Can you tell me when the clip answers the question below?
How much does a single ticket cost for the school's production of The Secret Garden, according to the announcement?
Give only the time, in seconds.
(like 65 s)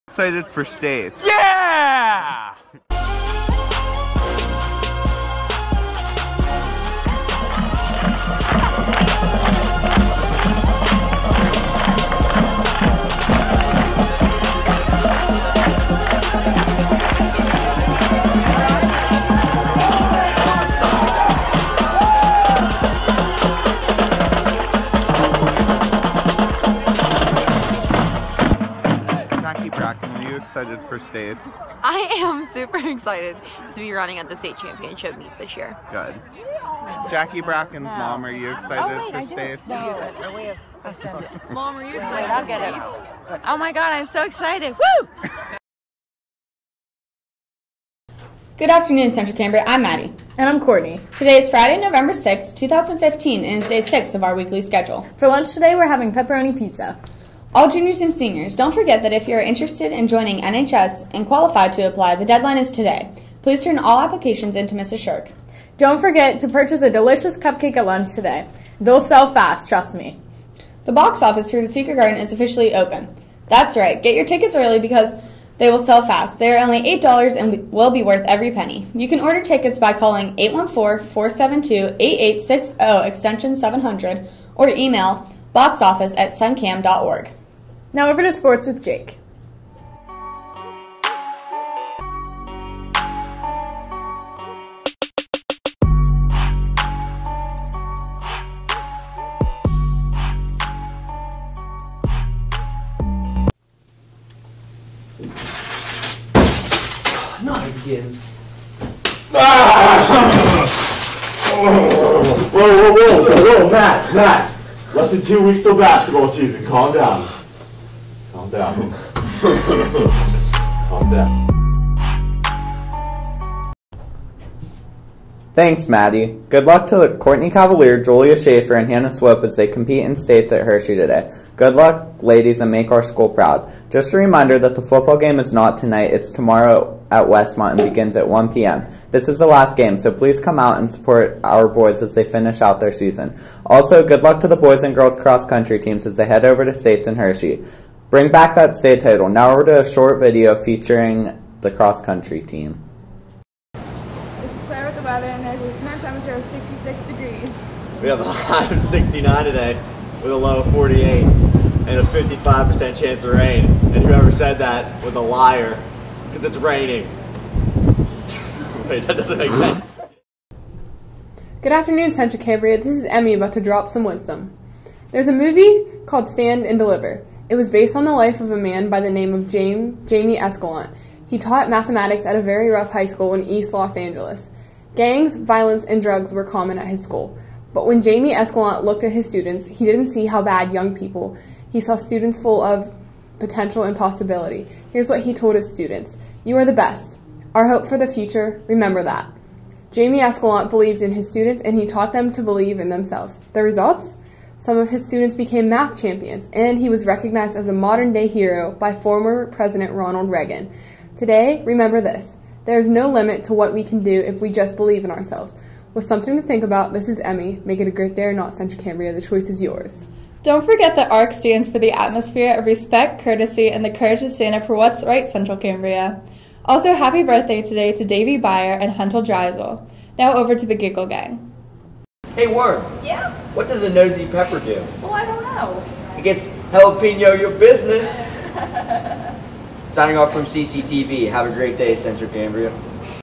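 76 s.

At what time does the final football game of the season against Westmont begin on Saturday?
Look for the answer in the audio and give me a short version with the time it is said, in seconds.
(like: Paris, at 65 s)
1 p.m., at 138 s.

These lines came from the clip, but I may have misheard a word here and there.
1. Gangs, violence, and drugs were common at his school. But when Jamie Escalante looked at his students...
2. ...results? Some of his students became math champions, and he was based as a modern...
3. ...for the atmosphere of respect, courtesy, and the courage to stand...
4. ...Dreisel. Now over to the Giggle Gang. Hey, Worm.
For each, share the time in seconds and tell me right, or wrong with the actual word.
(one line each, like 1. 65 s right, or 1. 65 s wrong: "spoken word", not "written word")
1. 184 s right
2. 203 s wrong: "recognized", not "based"
3. 221 s right
4. 229 s right.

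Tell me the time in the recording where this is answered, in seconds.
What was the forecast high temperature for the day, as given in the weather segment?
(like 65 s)
158 s.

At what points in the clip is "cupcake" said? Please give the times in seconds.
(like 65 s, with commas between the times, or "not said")
67 s.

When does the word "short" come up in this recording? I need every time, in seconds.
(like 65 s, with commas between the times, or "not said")
149 s.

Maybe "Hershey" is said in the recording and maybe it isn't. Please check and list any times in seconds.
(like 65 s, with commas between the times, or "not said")
130 s, 147 s.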